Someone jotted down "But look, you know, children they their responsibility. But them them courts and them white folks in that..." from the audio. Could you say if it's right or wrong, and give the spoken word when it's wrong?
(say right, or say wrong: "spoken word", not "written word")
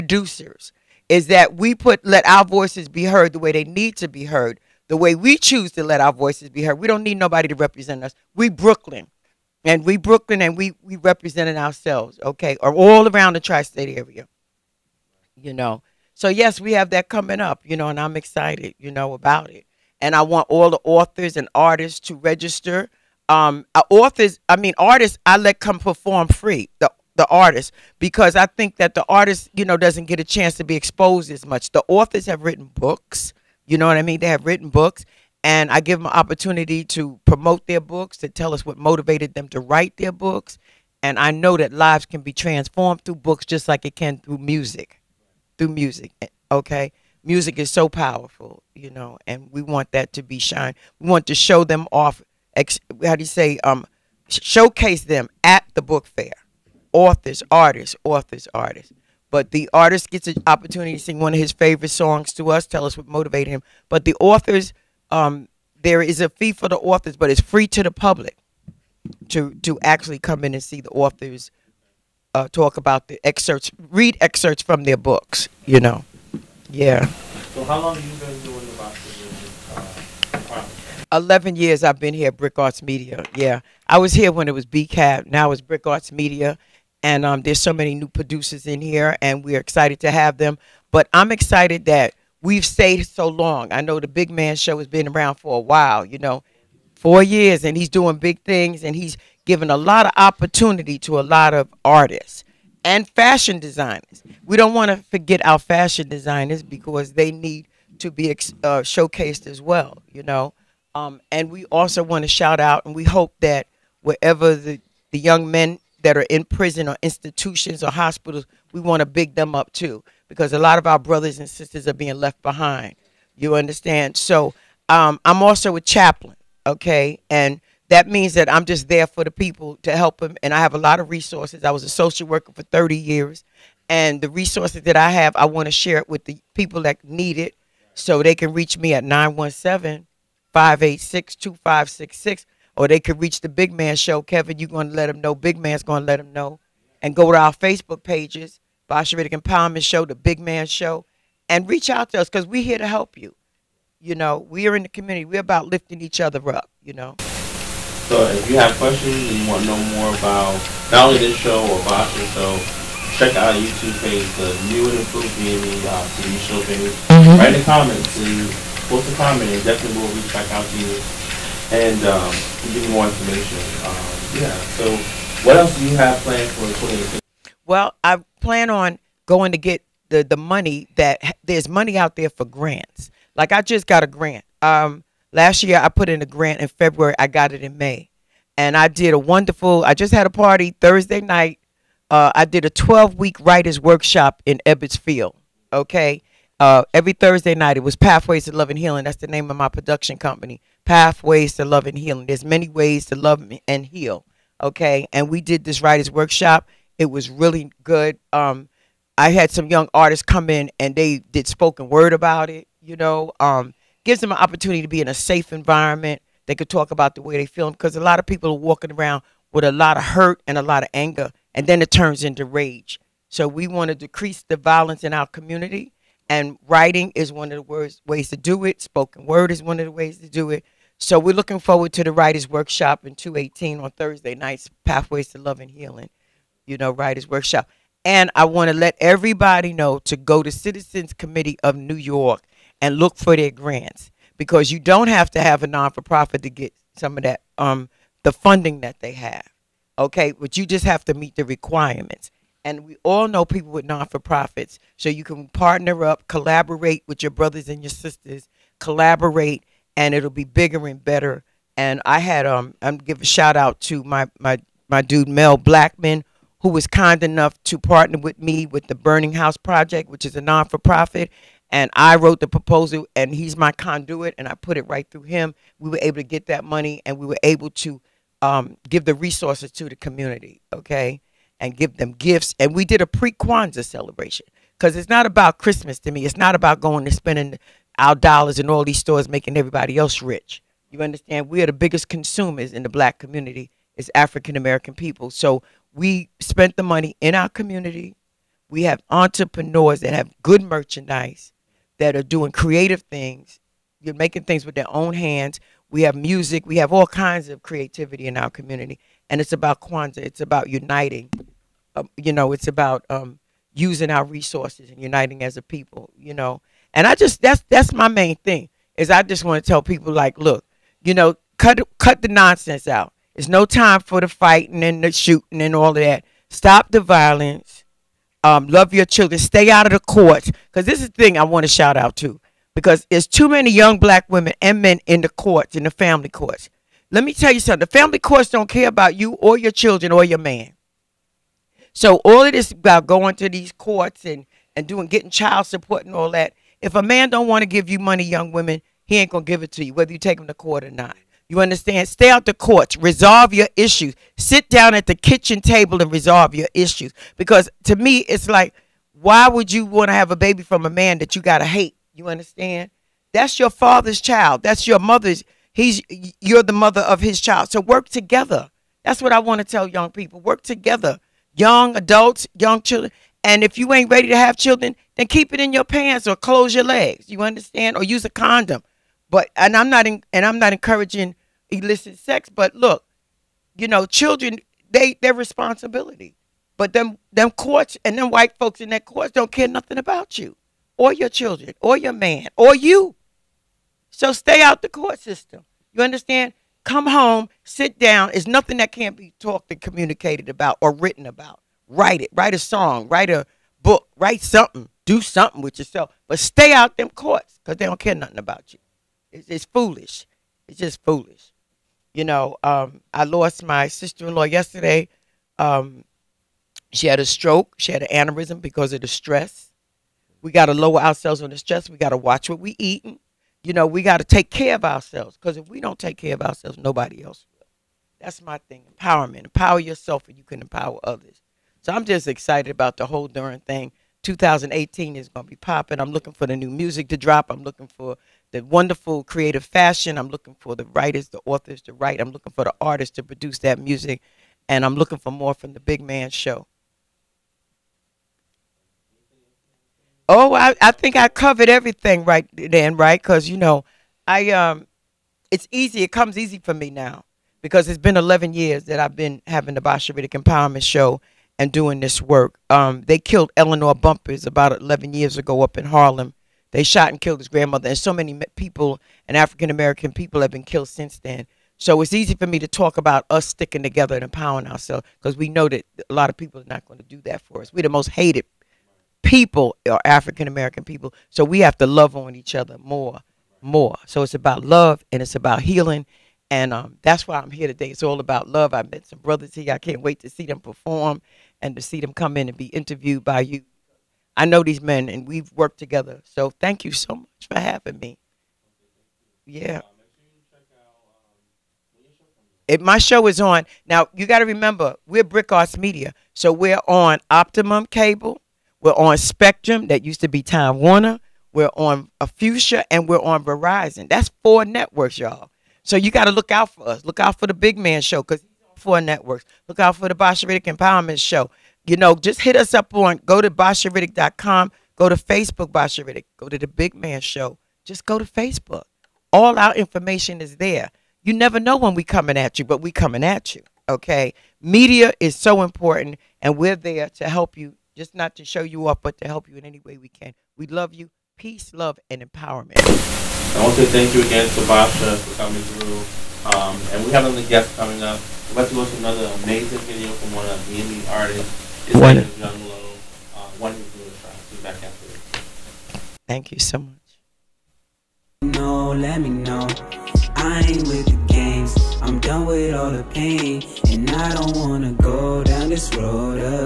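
right.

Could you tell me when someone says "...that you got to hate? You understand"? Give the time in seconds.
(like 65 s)
361 s.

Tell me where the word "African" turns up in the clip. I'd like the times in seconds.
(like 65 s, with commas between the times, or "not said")
294 s, 469 s, 480 s.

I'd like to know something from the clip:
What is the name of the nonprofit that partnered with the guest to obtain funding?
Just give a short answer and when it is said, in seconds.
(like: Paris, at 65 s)
Burning House Project, at 268 s.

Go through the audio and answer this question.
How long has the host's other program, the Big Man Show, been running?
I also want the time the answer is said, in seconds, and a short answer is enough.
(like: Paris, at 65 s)
4 years, at 96 s.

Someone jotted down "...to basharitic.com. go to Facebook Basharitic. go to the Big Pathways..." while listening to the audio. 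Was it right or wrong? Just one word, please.
wrong.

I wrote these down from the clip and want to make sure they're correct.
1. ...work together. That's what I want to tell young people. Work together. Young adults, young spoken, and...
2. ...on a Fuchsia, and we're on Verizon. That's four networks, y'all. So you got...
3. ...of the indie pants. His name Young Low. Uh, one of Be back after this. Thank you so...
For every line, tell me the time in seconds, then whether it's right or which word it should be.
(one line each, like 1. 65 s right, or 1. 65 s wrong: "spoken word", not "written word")
1. 367 s wrong: "children", not "spoken"
2. 511 s right
3. 550 s wrong: "artists", not "pants".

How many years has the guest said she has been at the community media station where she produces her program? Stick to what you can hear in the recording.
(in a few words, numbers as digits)
11.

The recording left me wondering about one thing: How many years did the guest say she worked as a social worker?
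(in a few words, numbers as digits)
30.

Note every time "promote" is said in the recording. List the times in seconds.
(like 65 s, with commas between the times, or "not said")
37 s.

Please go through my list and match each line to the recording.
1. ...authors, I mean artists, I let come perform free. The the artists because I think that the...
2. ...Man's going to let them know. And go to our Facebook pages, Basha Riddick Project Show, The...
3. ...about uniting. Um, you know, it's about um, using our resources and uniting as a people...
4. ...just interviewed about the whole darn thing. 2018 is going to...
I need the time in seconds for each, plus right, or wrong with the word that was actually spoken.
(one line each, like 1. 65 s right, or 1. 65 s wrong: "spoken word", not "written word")
1. 23 s right
2. 145 s wrong: "Empowerment", not "Project"
3. 310 s right
4. 432 s wrong: "excited", not "interviewed".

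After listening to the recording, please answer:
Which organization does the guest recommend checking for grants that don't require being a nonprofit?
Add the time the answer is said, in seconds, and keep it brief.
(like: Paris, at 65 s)
Citizens Committee of New York, at 240 s.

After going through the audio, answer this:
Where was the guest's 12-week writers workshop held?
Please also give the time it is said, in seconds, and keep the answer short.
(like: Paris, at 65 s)
Ebbets Field, at 194 s.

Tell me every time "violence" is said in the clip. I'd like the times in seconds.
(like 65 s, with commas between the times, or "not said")
224 s, 327 s.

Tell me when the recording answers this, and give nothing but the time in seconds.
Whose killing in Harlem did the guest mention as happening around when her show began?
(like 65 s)
463 s.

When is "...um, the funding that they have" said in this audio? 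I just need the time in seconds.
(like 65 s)
247 s.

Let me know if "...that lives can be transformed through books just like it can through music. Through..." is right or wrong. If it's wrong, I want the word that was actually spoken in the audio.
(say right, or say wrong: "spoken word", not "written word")
right.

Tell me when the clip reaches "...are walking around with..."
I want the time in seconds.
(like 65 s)
218 s.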